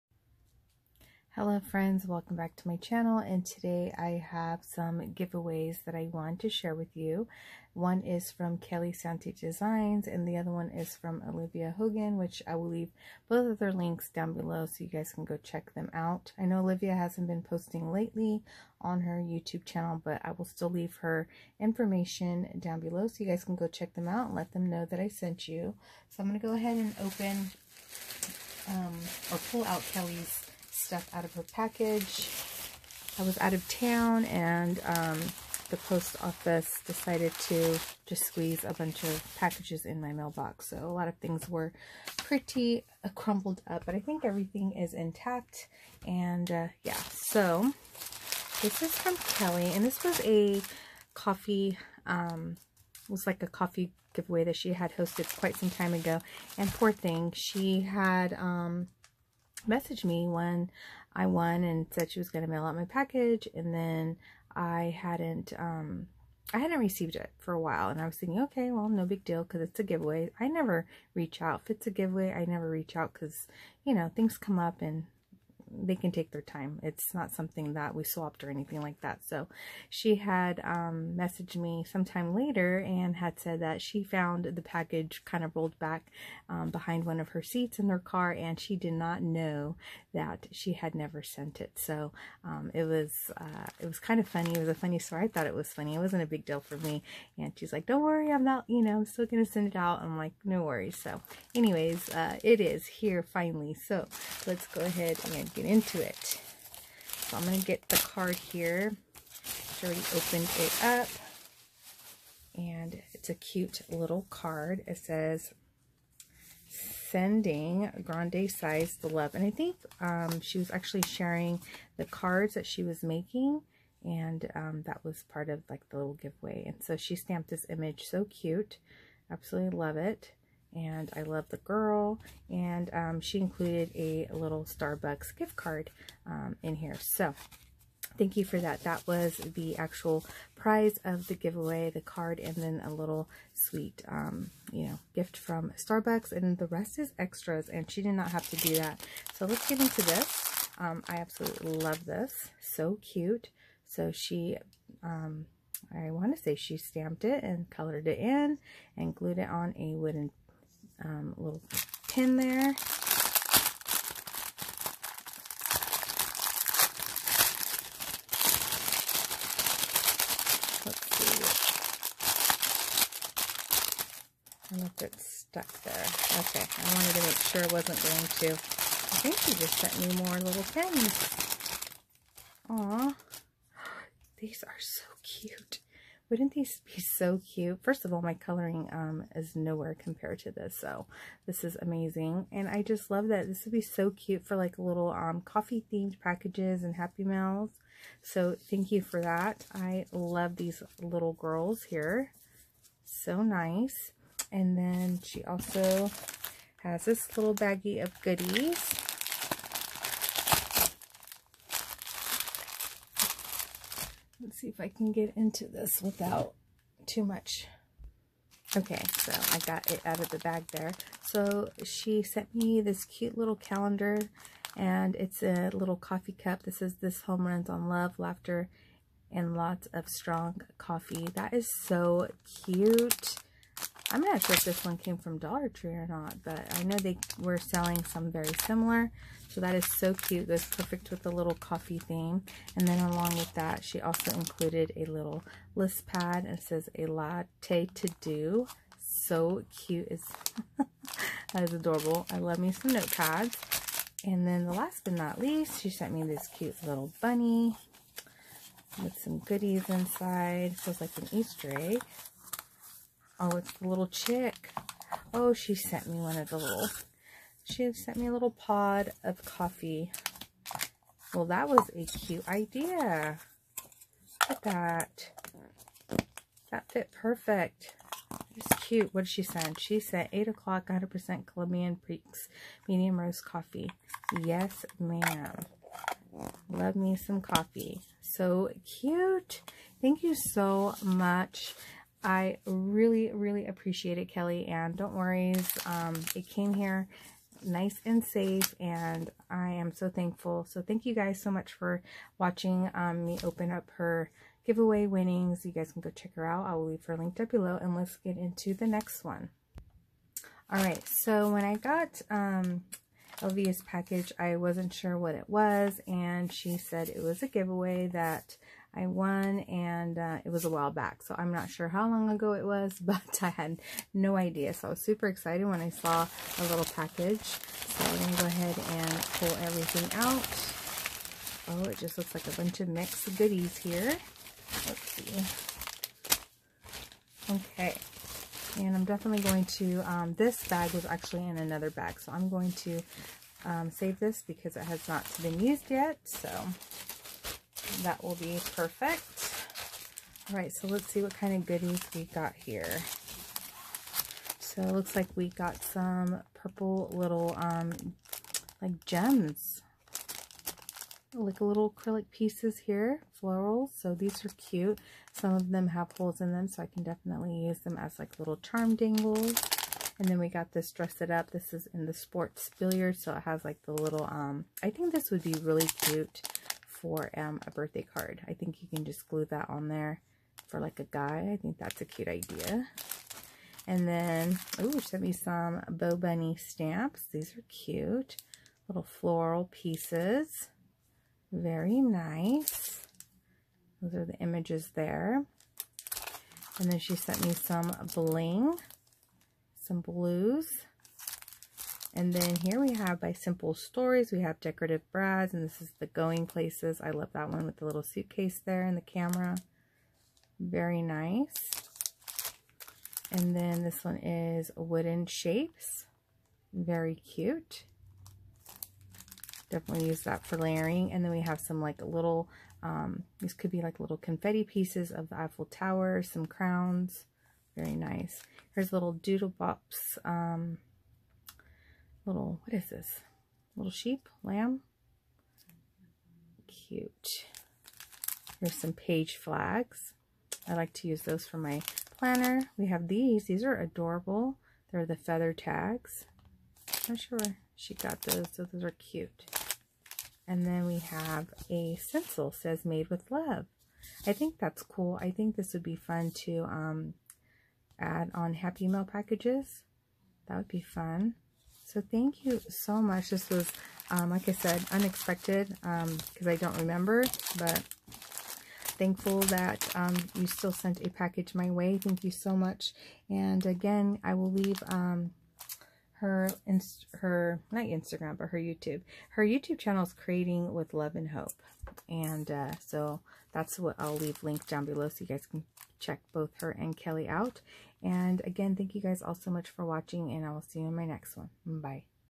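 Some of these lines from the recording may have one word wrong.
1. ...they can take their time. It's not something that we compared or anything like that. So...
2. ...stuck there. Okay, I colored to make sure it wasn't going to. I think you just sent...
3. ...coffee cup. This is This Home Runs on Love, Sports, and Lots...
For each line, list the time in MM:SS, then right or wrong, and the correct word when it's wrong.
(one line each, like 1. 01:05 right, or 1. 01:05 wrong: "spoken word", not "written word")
1. 01:15 wrong: "swapped", not "compared"
2. 02:55 wrong: "wanted", not "colored"
3. 03:45 wrong: "Laughter", not "Sports".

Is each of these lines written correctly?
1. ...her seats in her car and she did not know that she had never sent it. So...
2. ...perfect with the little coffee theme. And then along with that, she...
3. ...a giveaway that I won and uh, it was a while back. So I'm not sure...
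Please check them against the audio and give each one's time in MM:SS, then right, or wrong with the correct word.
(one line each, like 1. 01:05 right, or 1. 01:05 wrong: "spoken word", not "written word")
1. 01:27 right
2. 04:00 right
3. 05:17 right.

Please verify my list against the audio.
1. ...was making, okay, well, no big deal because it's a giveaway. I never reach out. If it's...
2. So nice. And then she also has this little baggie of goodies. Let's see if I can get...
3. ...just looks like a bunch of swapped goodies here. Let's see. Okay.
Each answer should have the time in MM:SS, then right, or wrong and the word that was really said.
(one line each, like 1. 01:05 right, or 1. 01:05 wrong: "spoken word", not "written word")
1. 01:08 wrong: "thinking", not "making"
2. 03:23 right
3. 05:31 wrong: "mixed", not "swapped".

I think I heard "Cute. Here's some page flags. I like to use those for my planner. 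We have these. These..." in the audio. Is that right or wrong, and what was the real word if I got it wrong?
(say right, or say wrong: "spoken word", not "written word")
right.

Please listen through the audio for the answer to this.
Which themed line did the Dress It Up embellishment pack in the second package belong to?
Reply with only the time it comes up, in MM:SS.
06:12.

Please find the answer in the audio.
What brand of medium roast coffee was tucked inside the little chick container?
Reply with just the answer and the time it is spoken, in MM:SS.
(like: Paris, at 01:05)
8 o'clock, at 04:40.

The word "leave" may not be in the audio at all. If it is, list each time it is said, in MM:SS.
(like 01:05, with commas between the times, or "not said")
00:12, 00:20, 05:06, 07:54, 08:04.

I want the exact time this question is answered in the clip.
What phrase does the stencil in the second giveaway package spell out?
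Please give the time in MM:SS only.
07:32.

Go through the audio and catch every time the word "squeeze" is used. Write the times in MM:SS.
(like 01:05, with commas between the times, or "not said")
00:38.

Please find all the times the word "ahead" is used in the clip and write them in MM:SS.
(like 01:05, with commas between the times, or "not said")
00:26, 01:44, 05:28.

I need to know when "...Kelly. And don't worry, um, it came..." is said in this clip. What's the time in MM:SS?
04:54.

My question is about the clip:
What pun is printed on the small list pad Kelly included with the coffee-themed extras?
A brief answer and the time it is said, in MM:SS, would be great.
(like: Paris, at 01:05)
A latte to do, at 04:06.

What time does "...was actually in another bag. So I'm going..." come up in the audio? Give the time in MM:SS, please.
05:40.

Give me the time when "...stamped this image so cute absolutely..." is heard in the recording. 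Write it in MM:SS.
02:07.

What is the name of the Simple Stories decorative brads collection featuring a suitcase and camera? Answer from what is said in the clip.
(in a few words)
Going Places.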